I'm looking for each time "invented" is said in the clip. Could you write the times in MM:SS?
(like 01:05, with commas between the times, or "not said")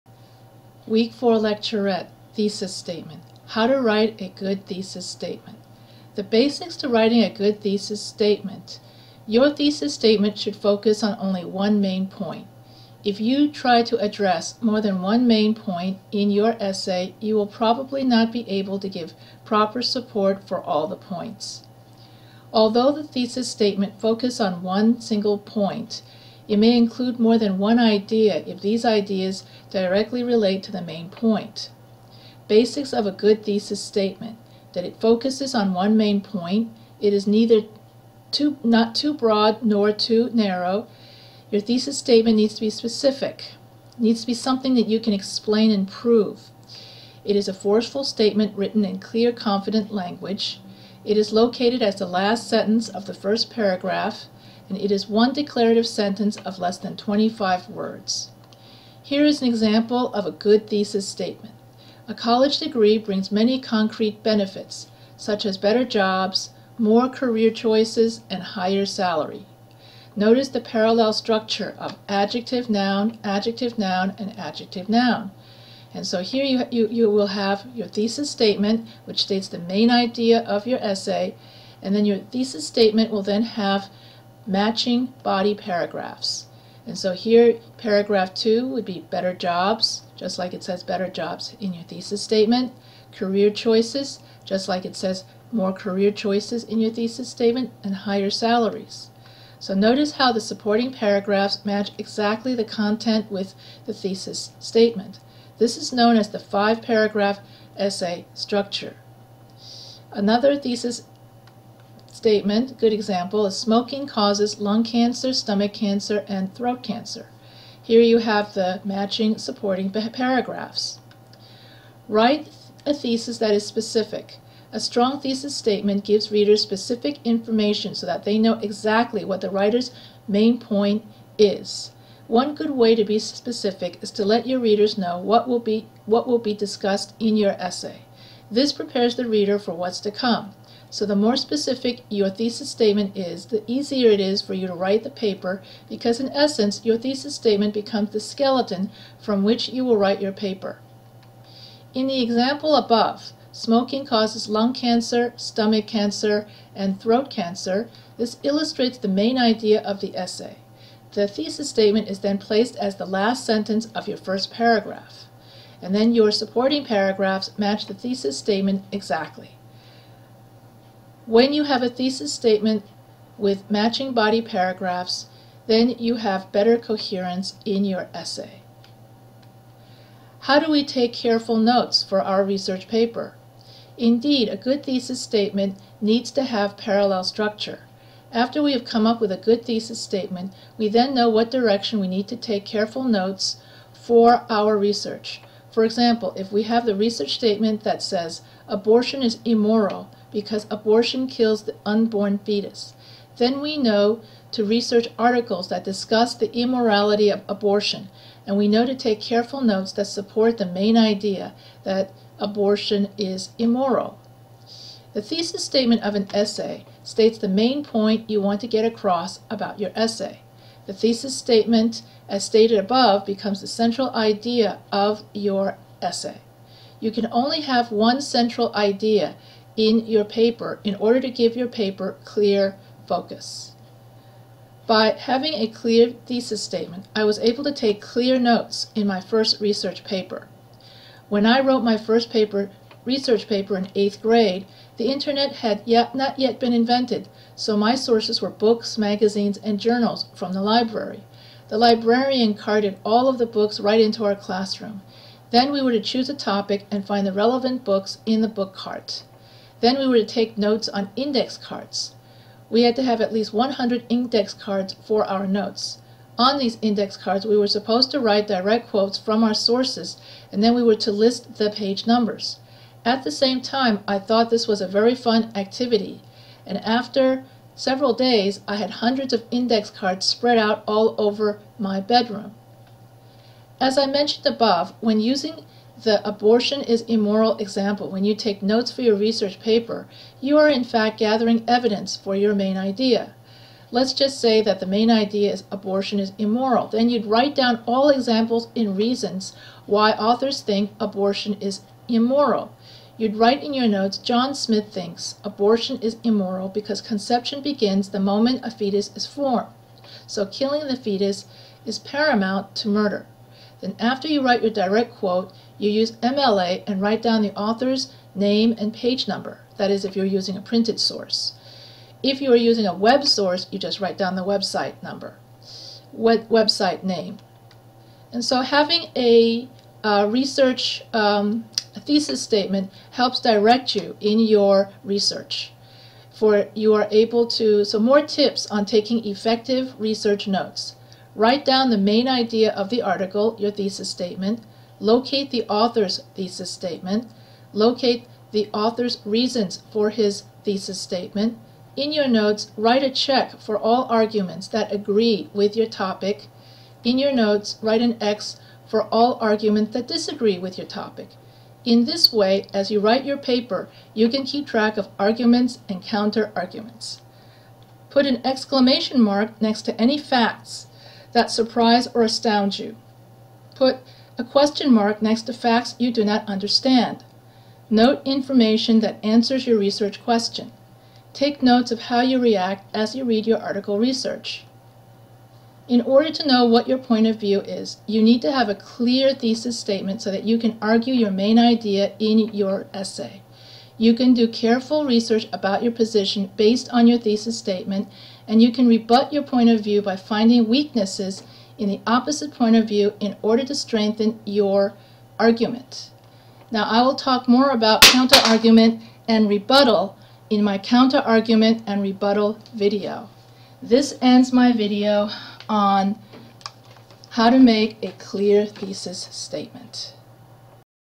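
04:06.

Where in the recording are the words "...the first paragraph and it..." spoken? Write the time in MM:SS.
00:53.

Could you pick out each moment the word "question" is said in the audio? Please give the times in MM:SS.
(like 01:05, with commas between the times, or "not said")
06:14, 06:20.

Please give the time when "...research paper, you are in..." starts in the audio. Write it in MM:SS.
04:49.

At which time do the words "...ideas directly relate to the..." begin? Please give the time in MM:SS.
00:28.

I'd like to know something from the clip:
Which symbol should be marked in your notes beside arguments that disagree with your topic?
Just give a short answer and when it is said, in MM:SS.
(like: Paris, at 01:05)
X, at 05:58.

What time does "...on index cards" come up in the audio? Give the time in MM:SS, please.
04:20.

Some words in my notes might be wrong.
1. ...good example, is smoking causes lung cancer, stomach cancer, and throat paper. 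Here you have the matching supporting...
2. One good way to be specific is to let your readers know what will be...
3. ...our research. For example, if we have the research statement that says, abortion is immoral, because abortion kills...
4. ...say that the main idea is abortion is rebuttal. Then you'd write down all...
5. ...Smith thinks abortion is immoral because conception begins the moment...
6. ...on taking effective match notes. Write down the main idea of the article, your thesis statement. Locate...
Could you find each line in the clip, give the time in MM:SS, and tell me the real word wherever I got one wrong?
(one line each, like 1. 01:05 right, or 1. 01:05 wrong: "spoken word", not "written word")
1. 01:52 wrong: "cancer", not "paper"
2. 02:12 right
3. 03:14 right
4. 04:54 wrong: "immoral", not "rebuttal"
5. 05:04 right
6. 05:38 wrong: "research", not "match".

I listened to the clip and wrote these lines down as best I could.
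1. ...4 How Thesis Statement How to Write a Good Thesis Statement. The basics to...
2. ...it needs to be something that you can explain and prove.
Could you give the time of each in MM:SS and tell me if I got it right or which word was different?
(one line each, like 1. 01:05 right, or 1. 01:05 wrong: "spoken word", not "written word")
1. 00:01 wrong: "Lecturette", not "How"
2. 00:43 right.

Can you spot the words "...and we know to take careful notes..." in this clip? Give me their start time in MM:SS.
03:28.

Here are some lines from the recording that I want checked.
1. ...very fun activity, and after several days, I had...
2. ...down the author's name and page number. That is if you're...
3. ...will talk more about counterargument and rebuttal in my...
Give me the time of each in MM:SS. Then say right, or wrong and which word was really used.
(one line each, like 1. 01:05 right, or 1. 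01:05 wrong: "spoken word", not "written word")
1. 04:34 right
2. 05:17 right
3. 06:47 right.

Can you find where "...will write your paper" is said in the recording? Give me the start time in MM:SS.
02:29.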